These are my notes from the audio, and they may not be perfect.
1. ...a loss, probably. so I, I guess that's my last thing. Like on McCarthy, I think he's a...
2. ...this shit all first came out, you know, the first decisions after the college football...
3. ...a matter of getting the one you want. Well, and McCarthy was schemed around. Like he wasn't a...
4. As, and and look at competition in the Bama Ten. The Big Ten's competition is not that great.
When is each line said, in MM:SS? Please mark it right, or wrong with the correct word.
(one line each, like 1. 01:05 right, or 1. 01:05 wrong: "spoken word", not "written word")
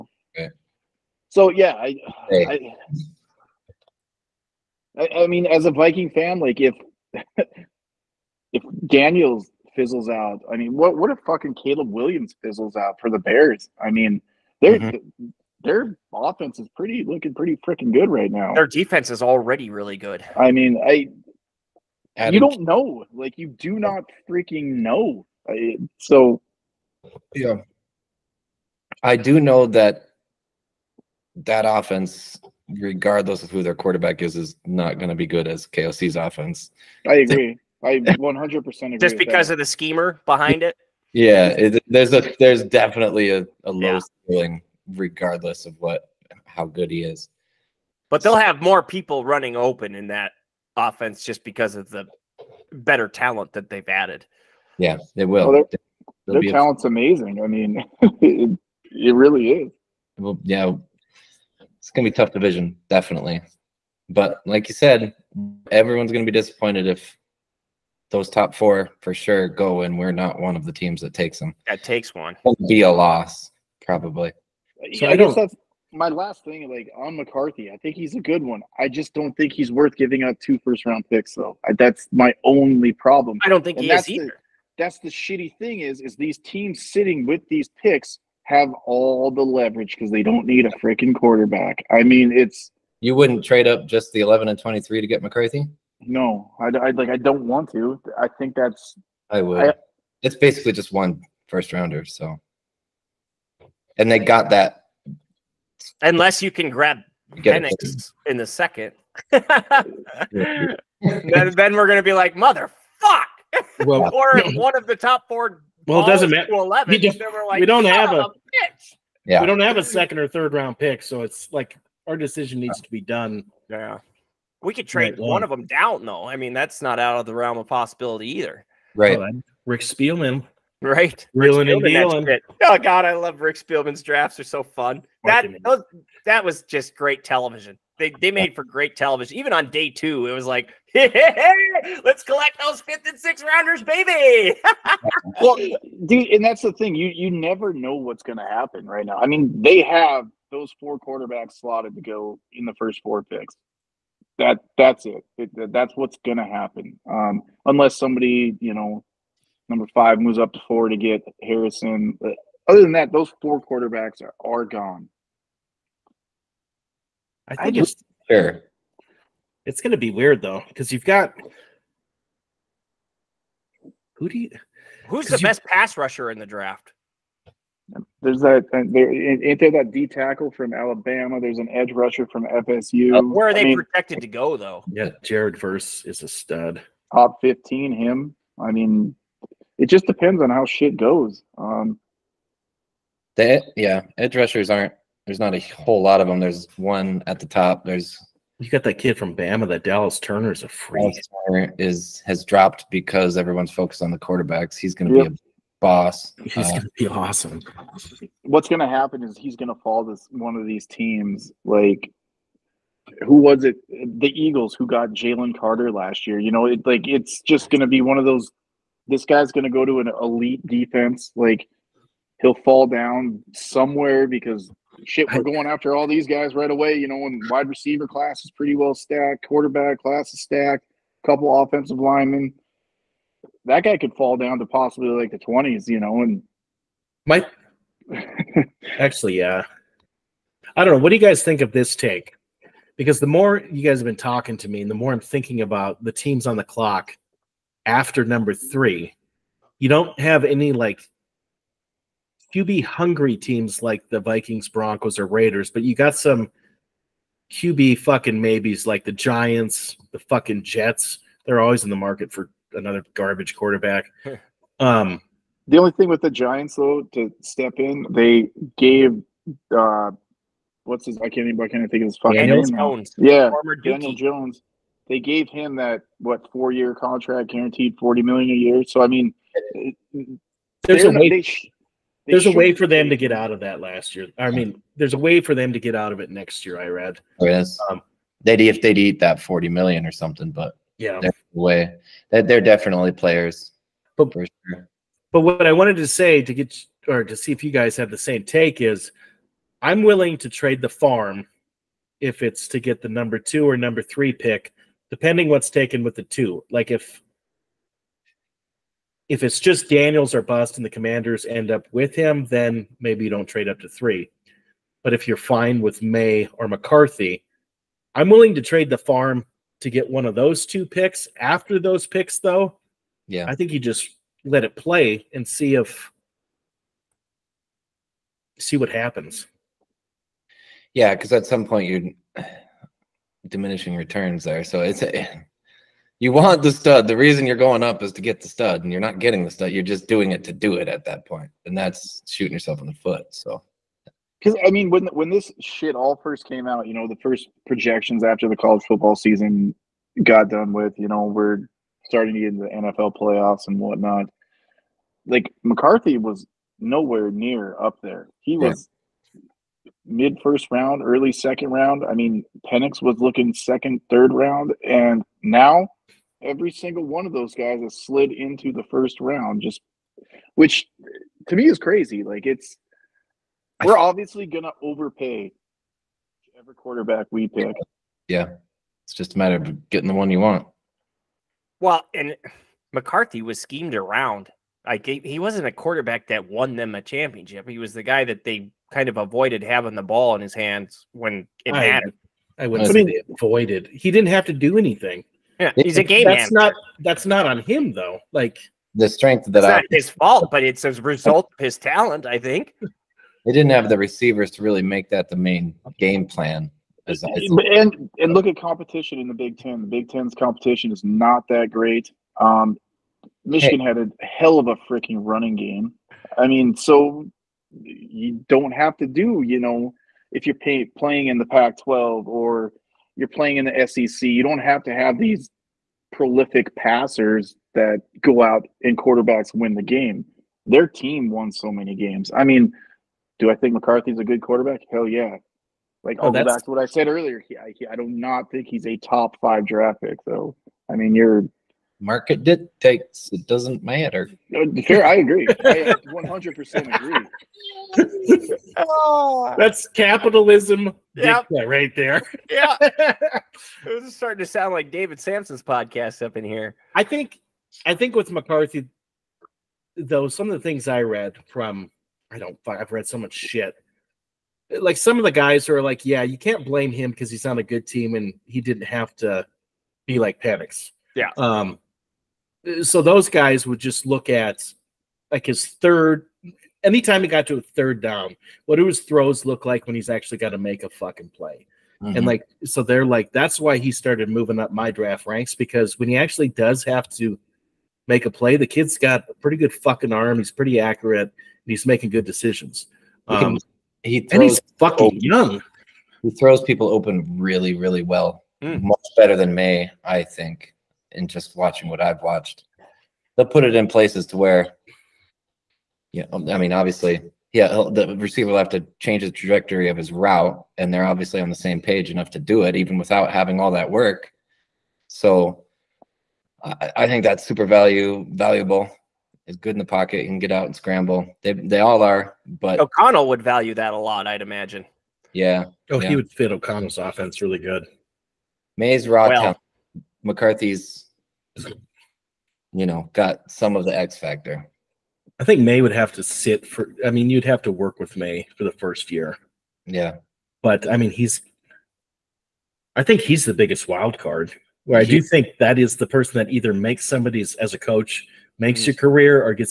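1. 01:12 right
2. 05:45 wrong: "projections", not "decisions"
3. 06:19 right
4. 06:47 wrong: "Big", not "Bama".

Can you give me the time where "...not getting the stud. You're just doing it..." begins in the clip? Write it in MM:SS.
05:39.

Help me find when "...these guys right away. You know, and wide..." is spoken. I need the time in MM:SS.
03:46.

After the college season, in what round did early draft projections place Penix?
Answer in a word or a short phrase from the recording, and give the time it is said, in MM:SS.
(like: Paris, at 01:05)
Second, third round, at 06:03.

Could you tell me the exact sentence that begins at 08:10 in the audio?
He's pretty accurate he's making good decisions.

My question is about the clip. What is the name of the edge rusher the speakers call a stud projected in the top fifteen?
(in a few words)
Jared Verse.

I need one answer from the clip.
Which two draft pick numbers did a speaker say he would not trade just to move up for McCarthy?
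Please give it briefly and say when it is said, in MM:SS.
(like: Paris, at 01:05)
11 and 23, at 01:34.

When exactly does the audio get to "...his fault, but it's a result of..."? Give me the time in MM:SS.
06:39.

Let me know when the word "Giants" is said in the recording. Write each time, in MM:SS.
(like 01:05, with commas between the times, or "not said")
04:19, 04:26.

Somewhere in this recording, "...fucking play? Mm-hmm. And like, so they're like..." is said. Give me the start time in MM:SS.
08:00.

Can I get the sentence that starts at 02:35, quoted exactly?
it that's what's going to happen.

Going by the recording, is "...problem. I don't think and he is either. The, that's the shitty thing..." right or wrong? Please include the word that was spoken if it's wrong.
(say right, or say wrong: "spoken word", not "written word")
right.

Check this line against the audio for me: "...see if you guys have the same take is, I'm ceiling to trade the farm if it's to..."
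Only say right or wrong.
wrong.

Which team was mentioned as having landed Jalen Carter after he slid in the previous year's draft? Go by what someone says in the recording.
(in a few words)
The Eagles.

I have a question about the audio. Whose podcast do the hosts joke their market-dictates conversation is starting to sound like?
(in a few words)
David Samson.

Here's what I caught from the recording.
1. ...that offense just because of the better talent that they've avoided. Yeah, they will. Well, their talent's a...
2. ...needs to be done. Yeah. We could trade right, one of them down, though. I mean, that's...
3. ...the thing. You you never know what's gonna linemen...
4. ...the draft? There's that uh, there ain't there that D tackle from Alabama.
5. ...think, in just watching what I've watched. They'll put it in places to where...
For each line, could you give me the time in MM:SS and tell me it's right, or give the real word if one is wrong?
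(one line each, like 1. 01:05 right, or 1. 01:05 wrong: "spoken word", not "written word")
1. 00:50 wrong: "added", not "avoided"
2. 02:02 right
3. 02:26 wrong: "happen", not "linemen"
4. 02:56 right
5. 08:20 right.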